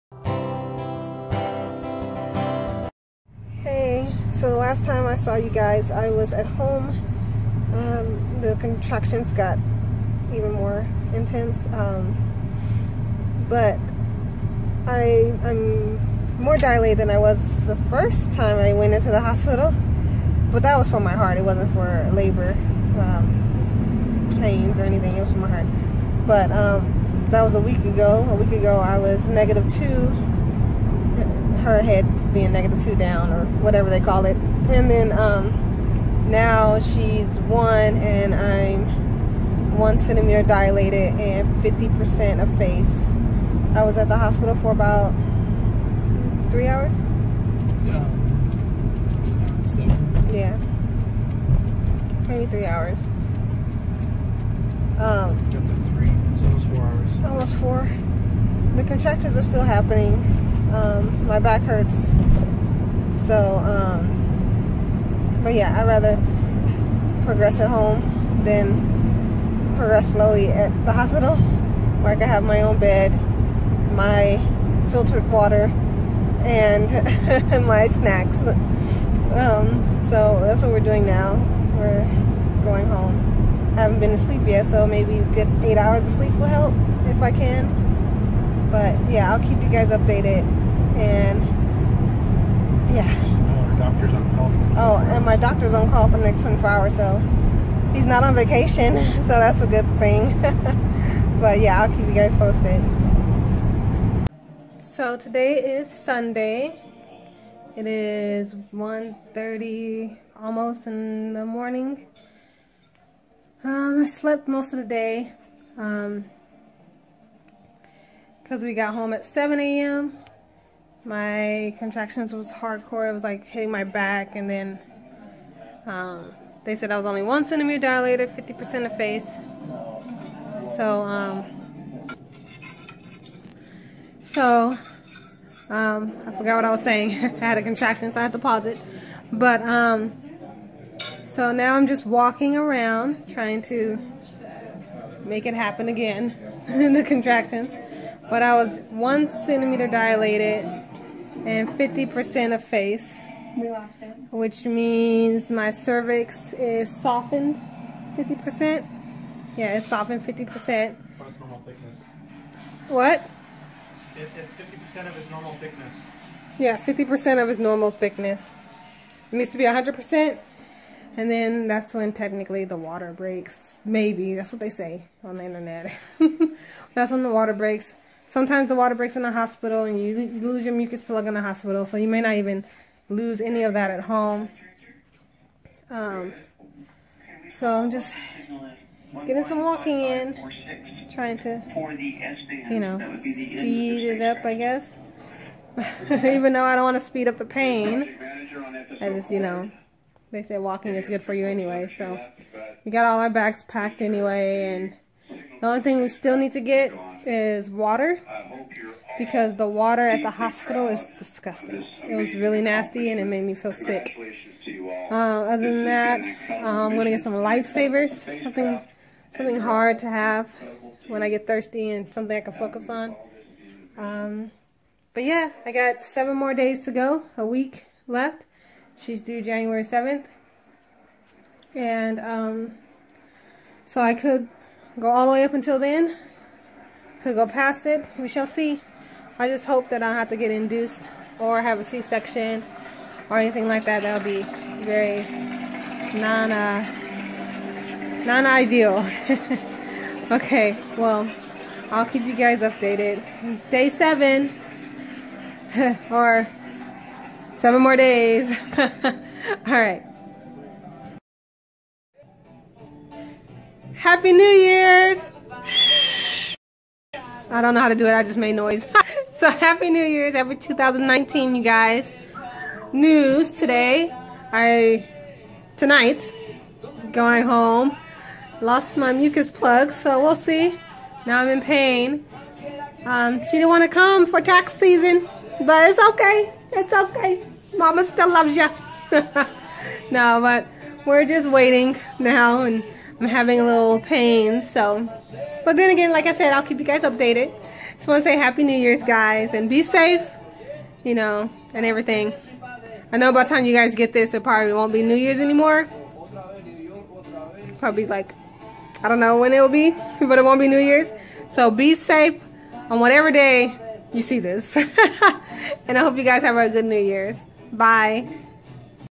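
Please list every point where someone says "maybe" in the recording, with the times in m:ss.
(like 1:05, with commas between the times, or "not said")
0:52, 1:24, 2:53.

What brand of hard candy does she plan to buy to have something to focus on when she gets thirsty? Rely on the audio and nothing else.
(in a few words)
Lifesavers.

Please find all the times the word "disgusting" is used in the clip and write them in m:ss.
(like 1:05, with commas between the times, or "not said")
3:31.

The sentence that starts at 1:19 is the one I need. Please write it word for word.
Um, so that's what we're doing now.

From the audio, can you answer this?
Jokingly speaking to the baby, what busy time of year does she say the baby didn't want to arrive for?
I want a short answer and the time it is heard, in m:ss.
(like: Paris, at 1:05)
Tax season, at 4:44.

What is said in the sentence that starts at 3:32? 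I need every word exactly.
It was really nasty and it made me feel sick.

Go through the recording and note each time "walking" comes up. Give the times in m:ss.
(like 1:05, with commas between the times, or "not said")
2:22, 3:09, 3:20.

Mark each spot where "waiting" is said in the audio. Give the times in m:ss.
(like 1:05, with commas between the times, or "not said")
4:51.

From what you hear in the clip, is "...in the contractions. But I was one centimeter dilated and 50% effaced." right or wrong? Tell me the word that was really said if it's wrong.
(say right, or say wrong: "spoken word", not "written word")
right.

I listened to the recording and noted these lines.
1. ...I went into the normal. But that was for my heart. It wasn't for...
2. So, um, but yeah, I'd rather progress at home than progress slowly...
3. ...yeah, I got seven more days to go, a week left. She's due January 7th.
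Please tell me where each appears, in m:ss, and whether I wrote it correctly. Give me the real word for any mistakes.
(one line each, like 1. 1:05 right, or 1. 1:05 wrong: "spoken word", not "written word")
1. 0:18 wrong: "hospital", not "normal"
2. 1:03 right
3. 3:45 right.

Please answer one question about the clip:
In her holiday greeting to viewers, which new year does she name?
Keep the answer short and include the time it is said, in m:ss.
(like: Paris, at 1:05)
2019, at 4:30.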